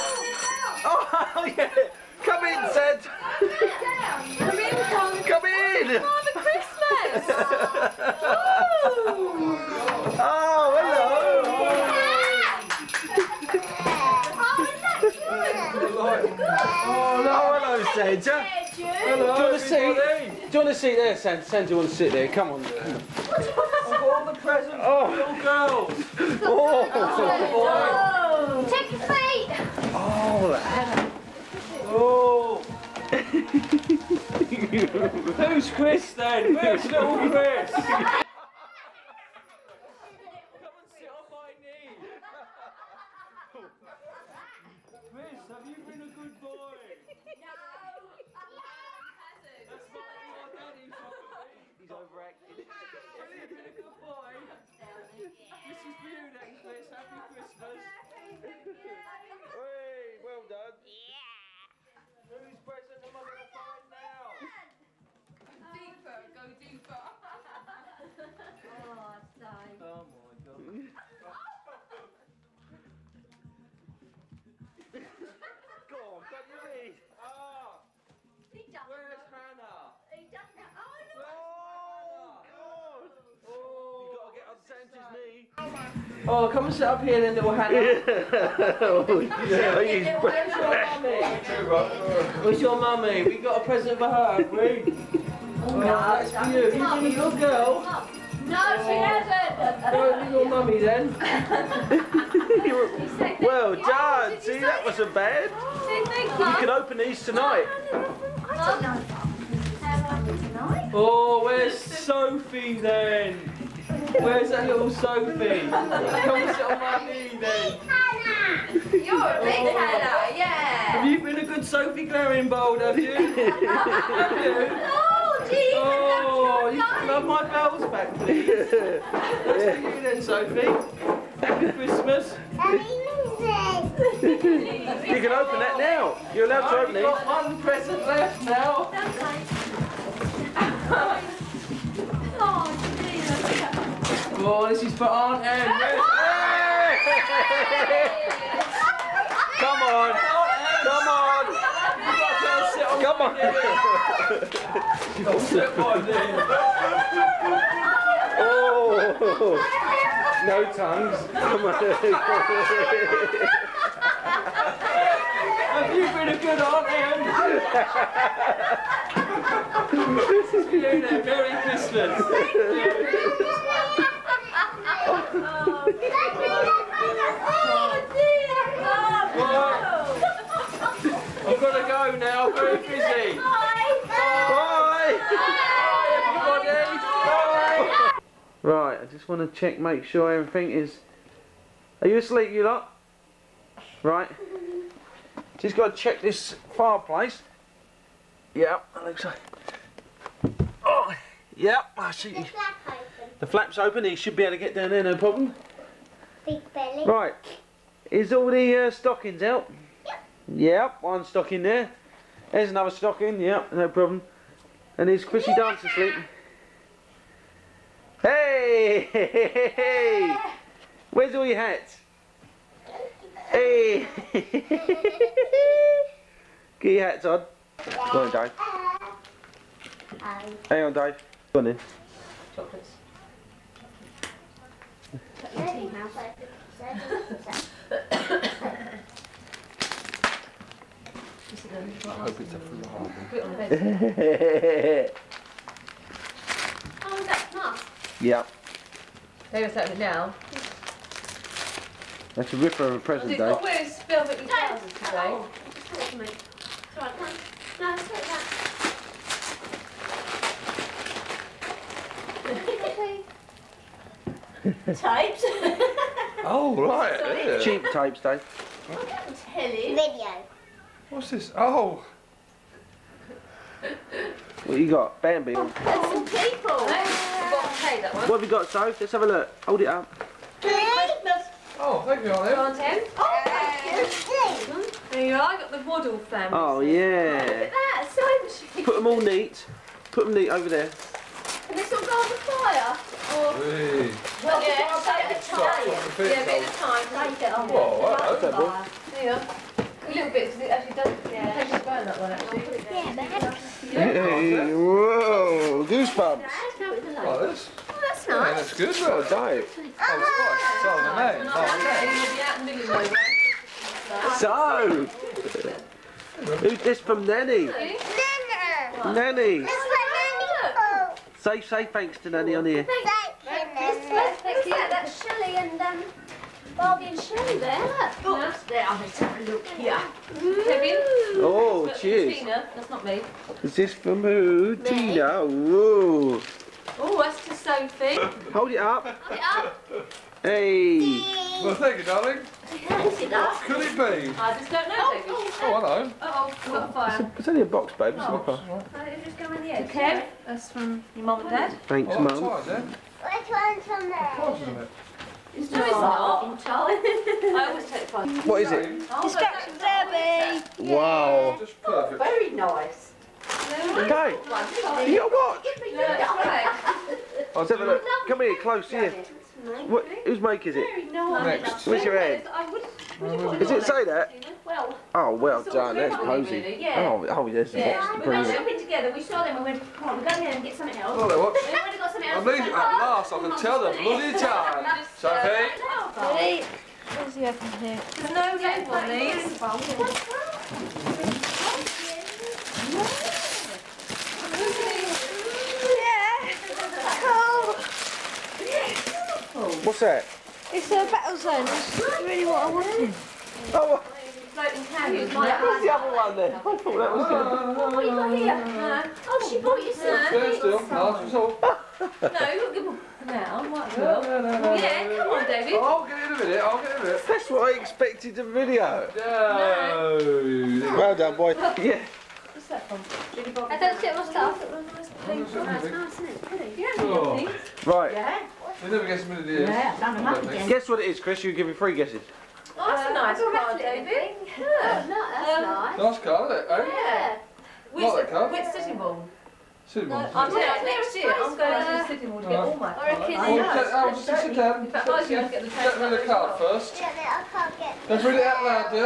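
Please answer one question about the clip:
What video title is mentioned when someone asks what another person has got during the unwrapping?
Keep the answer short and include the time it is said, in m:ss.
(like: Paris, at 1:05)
Bambi, at 4:35.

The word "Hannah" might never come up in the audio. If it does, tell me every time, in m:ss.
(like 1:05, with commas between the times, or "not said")
1:19, 1:59.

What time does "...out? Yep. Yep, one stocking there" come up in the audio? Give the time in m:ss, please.
3:29.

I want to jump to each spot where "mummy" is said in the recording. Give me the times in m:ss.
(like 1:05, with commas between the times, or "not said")
1:32, 1:40.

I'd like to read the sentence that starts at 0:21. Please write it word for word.
Santa, you want to sit there?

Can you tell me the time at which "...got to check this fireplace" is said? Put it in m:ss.
3:15.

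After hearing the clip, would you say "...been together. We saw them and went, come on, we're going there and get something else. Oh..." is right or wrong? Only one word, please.
right.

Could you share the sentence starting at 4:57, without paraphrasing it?
Like it on Whoa, the fire.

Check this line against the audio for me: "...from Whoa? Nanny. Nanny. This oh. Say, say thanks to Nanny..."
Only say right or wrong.
wrong.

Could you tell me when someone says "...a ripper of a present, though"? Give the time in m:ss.
4:12.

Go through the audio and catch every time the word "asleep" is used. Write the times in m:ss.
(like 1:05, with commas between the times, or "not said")
3:12.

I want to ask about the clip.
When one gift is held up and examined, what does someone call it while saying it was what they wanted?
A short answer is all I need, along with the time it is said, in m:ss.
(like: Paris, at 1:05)
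A battle zone, at 6:41.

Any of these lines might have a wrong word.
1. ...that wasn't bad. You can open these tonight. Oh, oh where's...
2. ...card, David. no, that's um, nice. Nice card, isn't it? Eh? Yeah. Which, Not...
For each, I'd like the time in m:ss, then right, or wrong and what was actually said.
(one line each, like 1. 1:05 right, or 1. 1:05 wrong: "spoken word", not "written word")
1. 1:44 right
2. 7:13 right.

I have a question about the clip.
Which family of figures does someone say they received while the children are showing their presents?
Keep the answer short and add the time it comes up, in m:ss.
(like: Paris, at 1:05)
The Waddle family, at 4:45.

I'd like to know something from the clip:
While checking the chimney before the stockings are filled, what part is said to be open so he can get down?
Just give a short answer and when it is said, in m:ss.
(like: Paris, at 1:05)
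The flap, at 3:23.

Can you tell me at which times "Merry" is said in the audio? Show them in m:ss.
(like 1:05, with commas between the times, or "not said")
2:51.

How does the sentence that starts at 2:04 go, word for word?
Oh, gee, oh, you can have my bells back, please.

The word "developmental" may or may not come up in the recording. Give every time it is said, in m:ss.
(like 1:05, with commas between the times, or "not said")
not said.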